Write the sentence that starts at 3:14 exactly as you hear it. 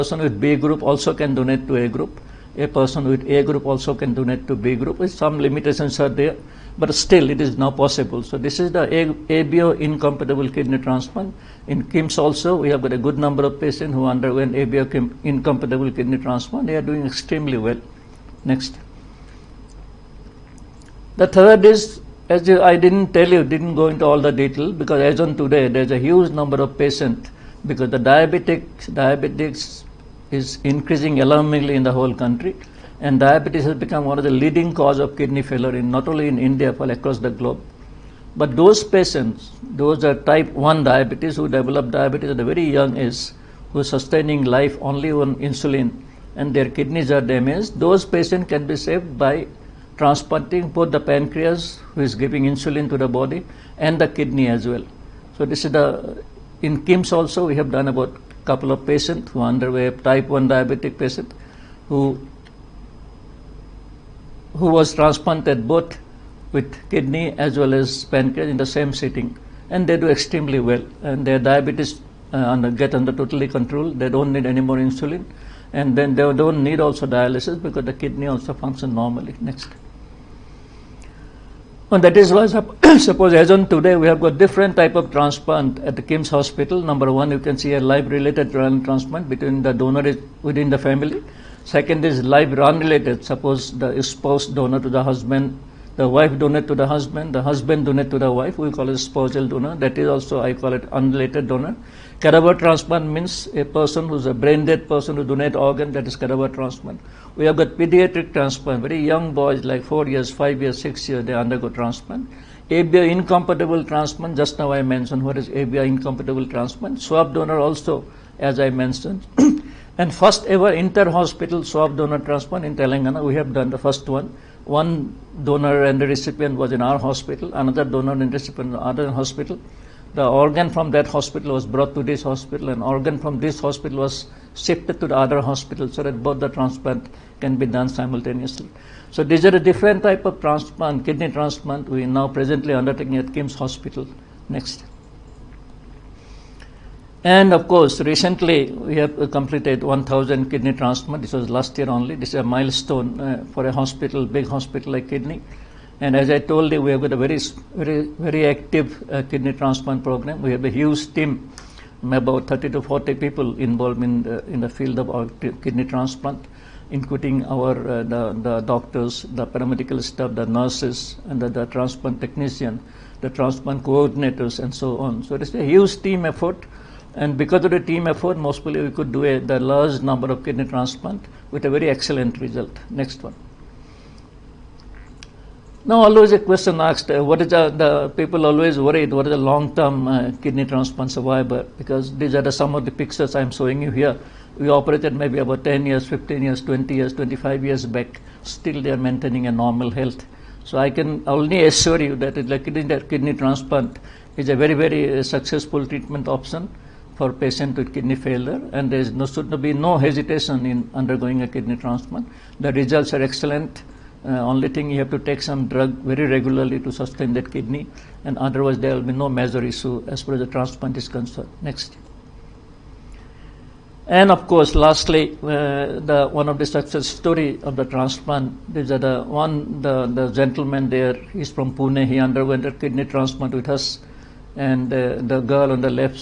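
We operated maybe about 10 years, 15 years, 20 years, 25 years back.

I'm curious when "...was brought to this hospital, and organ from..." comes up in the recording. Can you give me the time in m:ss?
2:11.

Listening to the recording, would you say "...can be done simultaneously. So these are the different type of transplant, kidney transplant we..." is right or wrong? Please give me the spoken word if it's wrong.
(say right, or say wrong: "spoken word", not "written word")
right.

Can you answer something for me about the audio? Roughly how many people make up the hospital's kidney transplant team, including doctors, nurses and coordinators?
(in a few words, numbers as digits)
30 to 40.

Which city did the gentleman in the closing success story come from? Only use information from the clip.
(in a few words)
Pune.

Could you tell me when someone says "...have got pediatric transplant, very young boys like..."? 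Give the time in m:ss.
1:47.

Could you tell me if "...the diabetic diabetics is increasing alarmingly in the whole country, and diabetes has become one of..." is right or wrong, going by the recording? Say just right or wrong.
right.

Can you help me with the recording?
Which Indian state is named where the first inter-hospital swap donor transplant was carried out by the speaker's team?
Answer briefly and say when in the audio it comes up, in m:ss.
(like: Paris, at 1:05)
Telangana, at 2:02.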